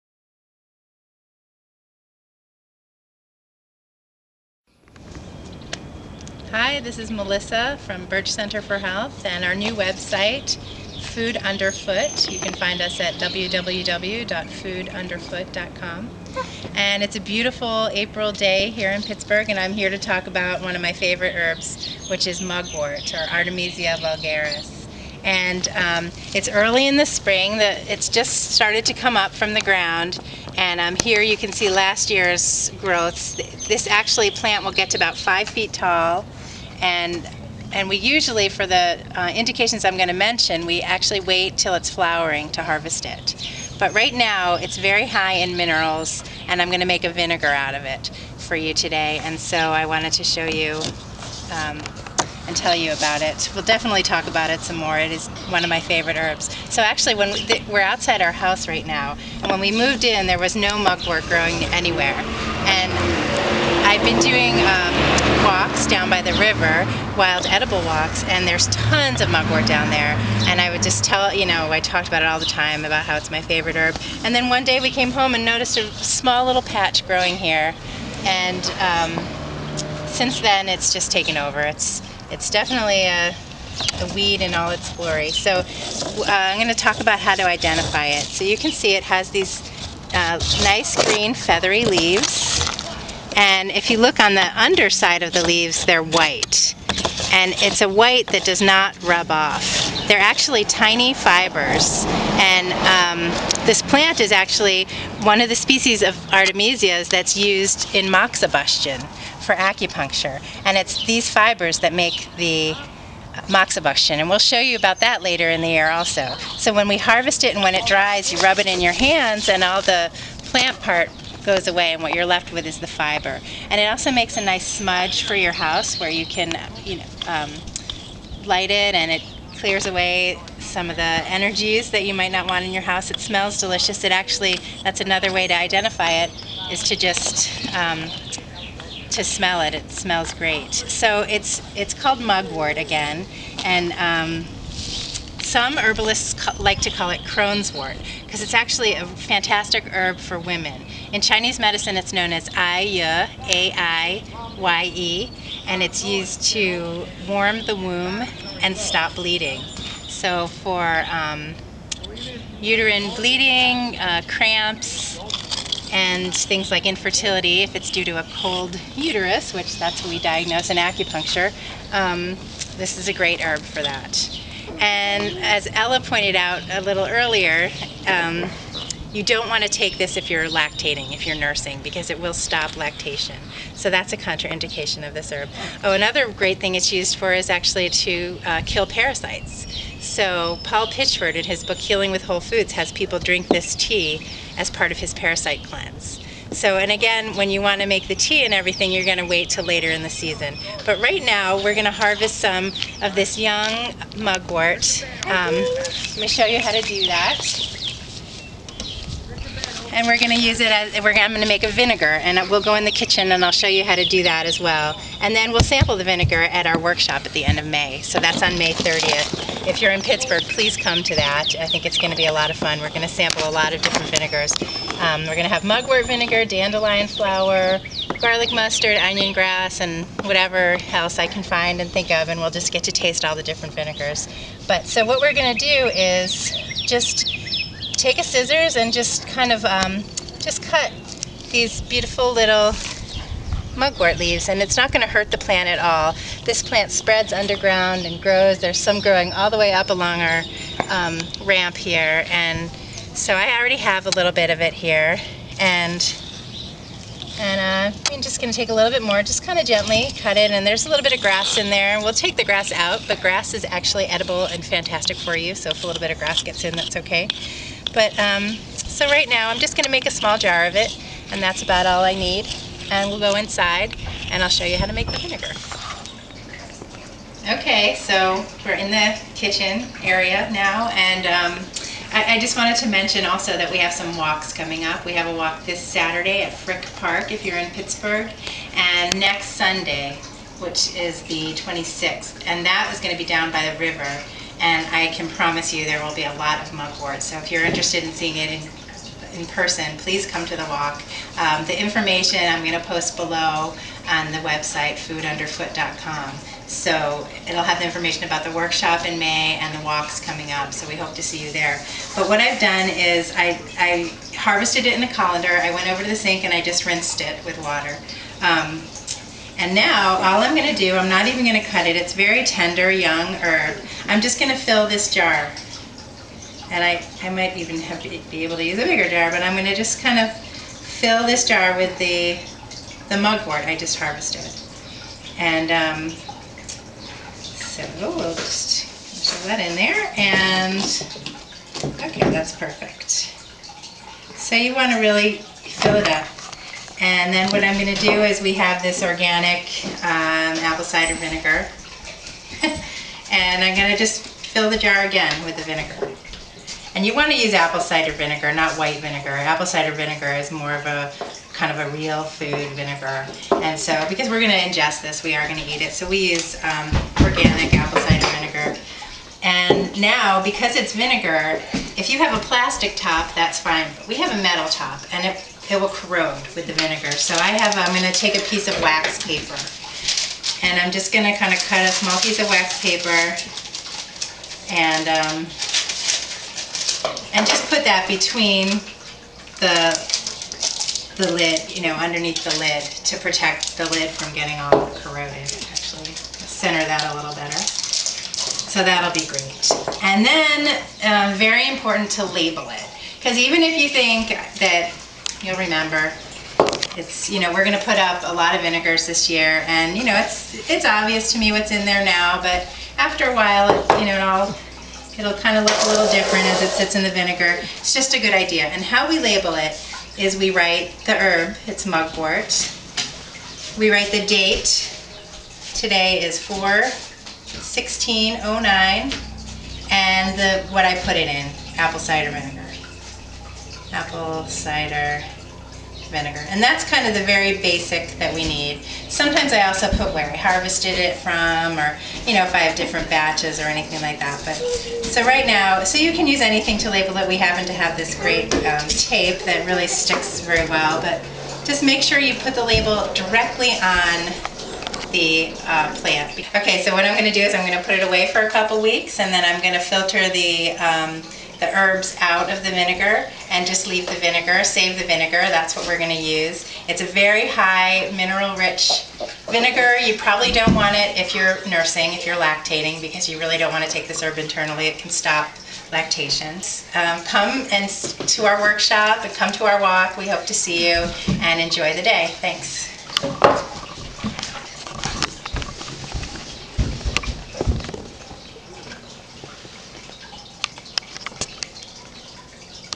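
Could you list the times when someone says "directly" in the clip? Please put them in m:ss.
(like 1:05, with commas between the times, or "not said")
7:33.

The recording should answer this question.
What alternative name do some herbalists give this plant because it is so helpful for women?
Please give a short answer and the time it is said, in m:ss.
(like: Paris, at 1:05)
Crone's wort, at 2:27.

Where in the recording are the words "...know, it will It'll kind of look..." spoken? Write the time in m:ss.
6:54.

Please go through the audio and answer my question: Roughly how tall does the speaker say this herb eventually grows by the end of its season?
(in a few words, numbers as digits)
5 feet.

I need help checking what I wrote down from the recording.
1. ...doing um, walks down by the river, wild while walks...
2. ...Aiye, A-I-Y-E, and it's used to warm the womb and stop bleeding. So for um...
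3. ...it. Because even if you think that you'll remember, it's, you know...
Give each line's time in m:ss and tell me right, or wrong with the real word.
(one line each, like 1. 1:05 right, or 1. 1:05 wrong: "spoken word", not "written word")
1. 1:04 wrong: "edible", not "while"
2. 2:32 right
3. 6:42 right.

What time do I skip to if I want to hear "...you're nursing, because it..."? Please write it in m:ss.
3:01.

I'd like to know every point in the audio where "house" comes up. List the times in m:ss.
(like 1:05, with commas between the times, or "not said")
0:58, 2:05, 2:12.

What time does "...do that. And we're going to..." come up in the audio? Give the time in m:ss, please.
3:26.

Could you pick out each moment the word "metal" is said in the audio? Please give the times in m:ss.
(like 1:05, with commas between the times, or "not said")
6:14.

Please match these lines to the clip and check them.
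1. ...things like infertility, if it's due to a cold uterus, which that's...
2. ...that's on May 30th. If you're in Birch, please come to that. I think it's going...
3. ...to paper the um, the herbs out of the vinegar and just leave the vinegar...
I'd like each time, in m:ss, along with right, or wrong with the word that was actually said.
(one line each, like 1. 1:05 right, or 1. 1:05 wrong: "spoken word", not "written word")
1. 2:46 right
2. 3:38 wrong: "Pittsburgh", not "Birch"
3. 7:39 wrong: "filter", not "paper".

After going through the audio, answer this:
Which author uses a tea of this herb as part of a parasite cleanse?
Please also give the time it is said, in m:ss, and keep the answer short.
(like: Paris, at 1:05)
Paul Pitchford, at 3:10.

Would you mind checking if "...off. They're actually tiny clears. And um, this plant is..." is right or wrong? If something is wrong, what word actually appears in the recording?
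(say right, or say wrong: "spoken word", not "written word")
wrong: "fibers", not "clears".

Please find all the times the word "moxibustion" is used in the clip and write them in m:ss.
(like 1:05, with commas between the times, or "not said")
1:48, 1:53.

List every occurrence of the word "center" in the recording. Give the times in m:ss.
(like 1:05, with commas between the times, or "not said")
0:08, 6:36.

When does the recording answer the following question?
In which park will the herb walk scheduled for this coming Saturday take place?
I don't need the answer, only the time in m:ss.
4:46.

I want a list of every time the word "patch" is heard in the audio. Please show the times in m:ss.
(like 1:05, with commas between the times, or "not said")
1:16.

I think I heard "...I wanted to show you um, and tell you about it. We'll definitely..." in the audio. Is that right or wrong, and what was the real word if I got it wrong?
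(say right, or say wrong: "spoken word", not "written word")
right.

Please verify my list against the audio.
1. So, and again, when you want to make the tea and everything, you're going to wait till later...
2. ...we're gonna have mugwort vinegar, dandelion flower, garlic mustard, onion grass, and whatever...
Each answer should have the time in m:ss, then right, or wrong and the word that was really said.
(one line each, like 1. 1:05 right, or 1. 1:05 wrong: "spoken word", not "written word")
1. 3:16 right
2. 3:45 right.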